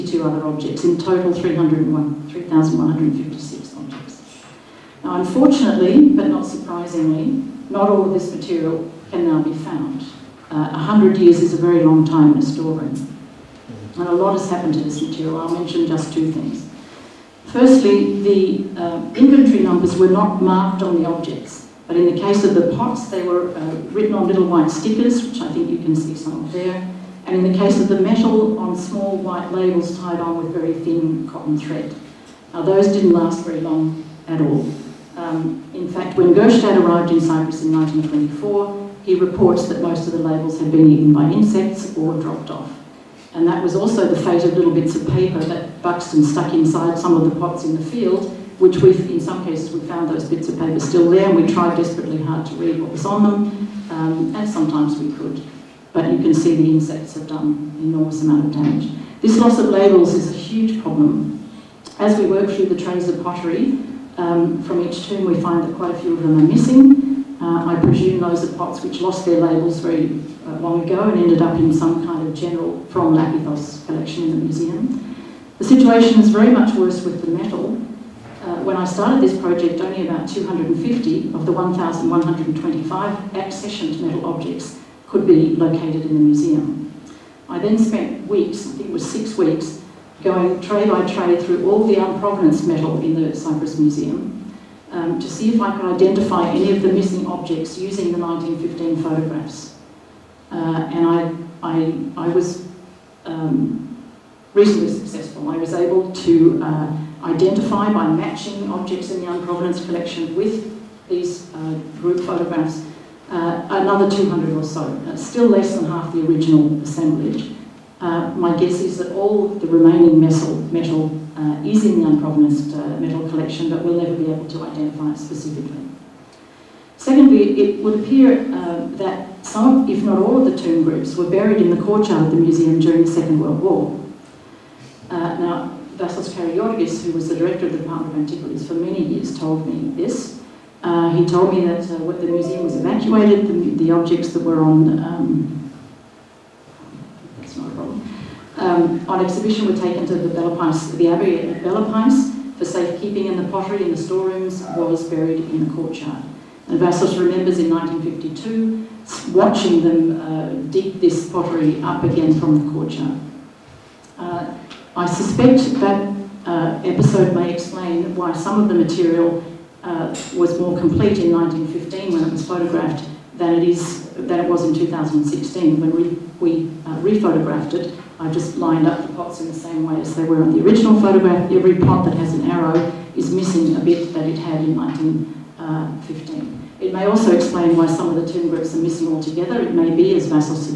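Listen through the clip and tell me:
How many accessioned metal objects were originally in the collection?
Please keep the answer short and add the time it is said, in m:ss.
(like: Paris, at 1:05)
1,125, at 1:21.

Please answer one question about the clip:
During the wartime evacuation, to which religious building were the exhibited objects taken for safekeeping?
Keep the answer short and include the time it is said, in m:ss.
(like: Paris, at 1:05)
Abbey at Bellapais, at 2:31.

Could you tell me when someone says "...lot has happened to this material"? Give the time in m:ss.
0:14.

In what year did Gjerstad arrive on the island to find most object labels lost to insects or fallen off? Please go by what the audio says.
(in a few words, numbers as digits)
1924.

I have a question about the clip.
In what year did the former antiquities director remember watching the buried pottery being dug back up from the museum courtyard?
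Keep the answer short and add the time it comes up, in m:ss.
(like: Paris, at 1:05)
1952, at 2:37.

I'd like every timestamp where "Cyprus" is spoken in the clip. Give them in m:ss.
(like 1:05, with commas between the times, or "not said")
0:37, 1:33.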